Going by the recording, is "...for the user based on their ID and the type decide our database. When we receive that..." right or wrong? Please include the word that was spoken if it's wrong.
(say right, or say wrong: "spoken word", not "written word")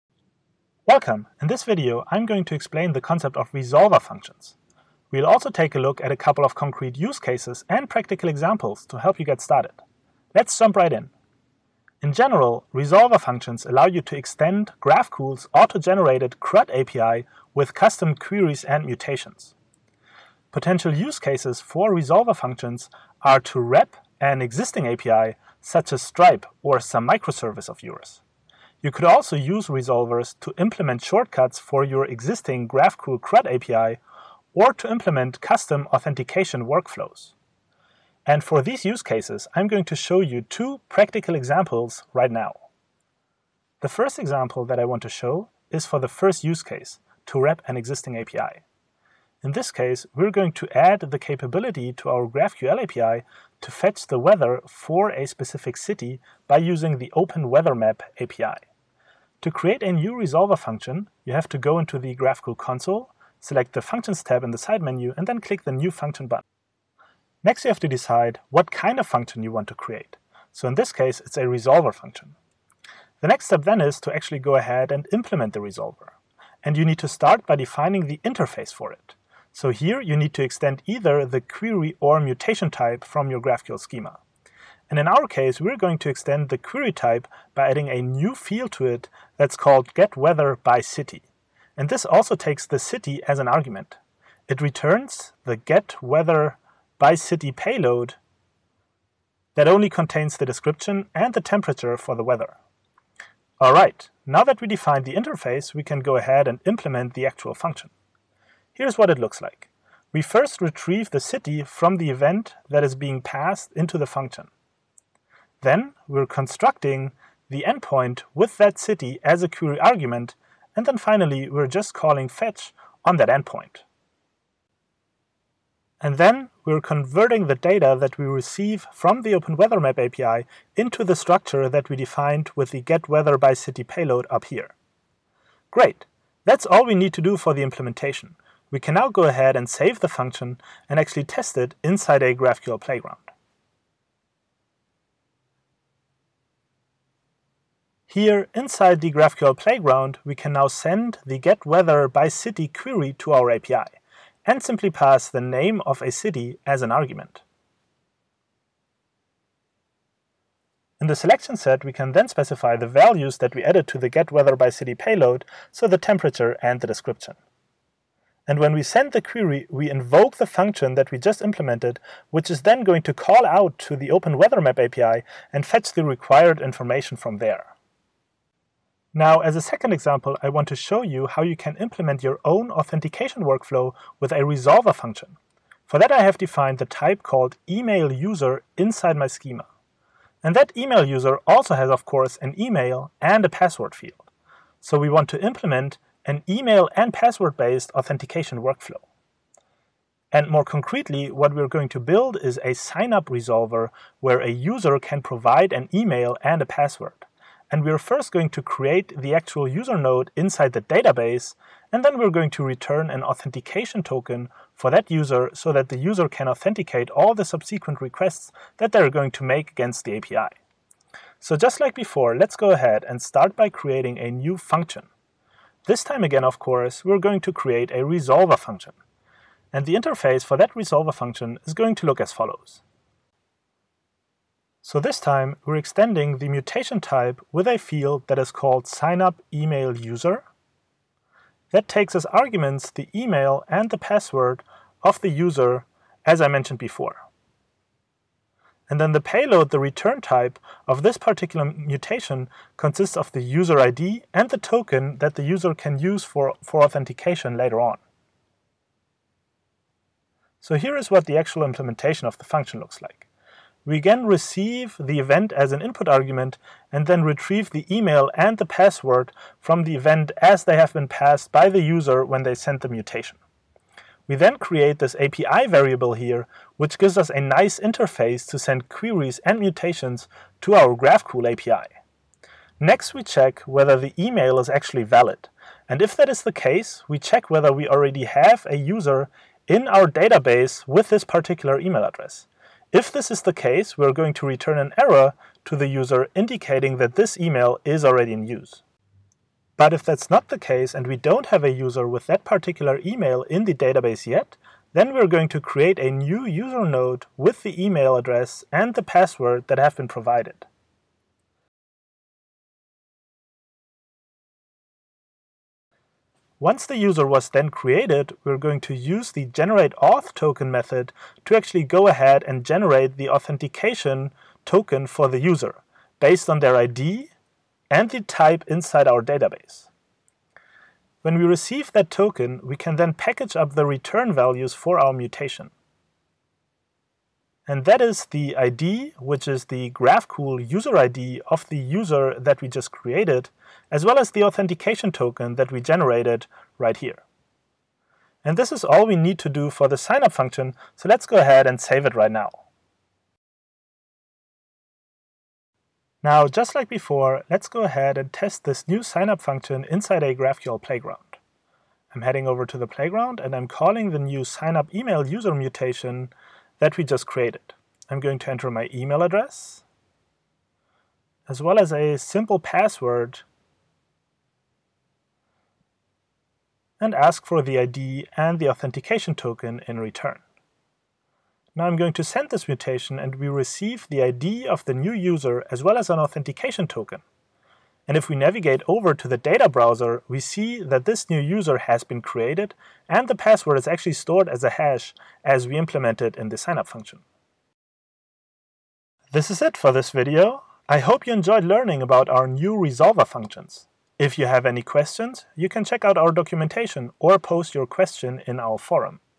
wrong: "inside", not "decide".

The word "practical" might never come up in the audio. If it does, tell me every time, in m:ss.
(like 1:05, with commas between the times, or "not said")
0:07, 0:40.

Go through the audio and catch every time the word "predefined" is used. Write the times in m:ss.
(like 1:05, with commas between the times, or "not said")
not said.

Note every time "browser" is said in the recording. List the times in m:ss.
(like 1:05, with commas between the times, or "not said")
6:29.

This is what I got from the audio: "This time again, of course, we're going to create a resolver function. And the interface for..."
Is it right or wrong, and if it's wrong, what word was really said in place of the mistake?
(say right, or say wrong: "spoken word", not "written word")
right.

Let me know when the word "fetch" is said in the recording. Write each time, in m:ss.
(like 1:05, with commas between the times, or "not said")
0:53, 2:02, 2:55.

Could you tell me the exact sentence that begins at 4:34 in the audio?
We then create this API variable here, which gives us a nice interface to send queries and mutations to our GraphQL API.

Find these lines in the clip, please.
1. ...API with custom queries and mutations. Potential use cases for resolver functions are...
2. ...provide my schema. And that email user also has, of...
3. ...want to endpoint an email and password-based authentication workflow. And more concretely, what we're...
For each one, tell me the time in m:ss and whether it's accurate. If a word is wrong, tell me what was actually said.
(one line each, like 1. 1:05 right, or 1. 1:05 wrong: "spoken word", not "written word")
1. 0:16 right
2. 3:08 wrong: "inside", not "provide"
3. 3:15 wrong: "implement", not "endpoint".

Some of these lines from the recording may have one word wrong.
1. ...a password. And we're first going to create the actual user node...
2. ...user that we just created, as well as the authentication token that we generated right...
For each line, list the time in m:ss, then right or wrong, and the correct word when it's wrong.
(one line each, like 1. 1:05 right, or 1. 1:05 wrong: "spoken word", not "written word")
1. 3:26 right
2. 5:41 right.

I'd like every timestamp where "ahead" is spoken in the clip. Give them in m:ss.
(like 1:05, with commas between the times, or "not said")
1:14, 1:46, 2:19, 3:42, 5:22, 5:51, 5:57.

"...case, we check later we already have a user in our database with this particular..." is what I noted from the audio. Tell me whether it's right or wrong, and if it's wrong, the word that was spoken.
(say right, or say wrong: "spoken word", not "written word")
wrong: "whether", not "later".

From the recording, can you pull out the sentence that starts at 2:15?
Great, that's all we need to do for the implementation.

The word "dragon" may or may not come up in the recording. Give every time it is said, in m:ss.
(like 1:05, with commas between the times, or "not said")
not said.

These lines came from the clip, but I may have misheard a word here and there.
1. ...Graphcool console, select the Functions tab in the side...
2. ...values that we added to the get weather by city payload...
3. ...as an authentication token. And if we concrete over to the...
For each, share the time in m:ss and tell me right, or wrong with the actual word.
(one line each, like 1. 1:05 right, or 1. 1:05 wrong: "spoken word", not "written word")
1. 1:02 right
2. 2:42 right
3. 6:25 wrong: "navigate", not "concrete".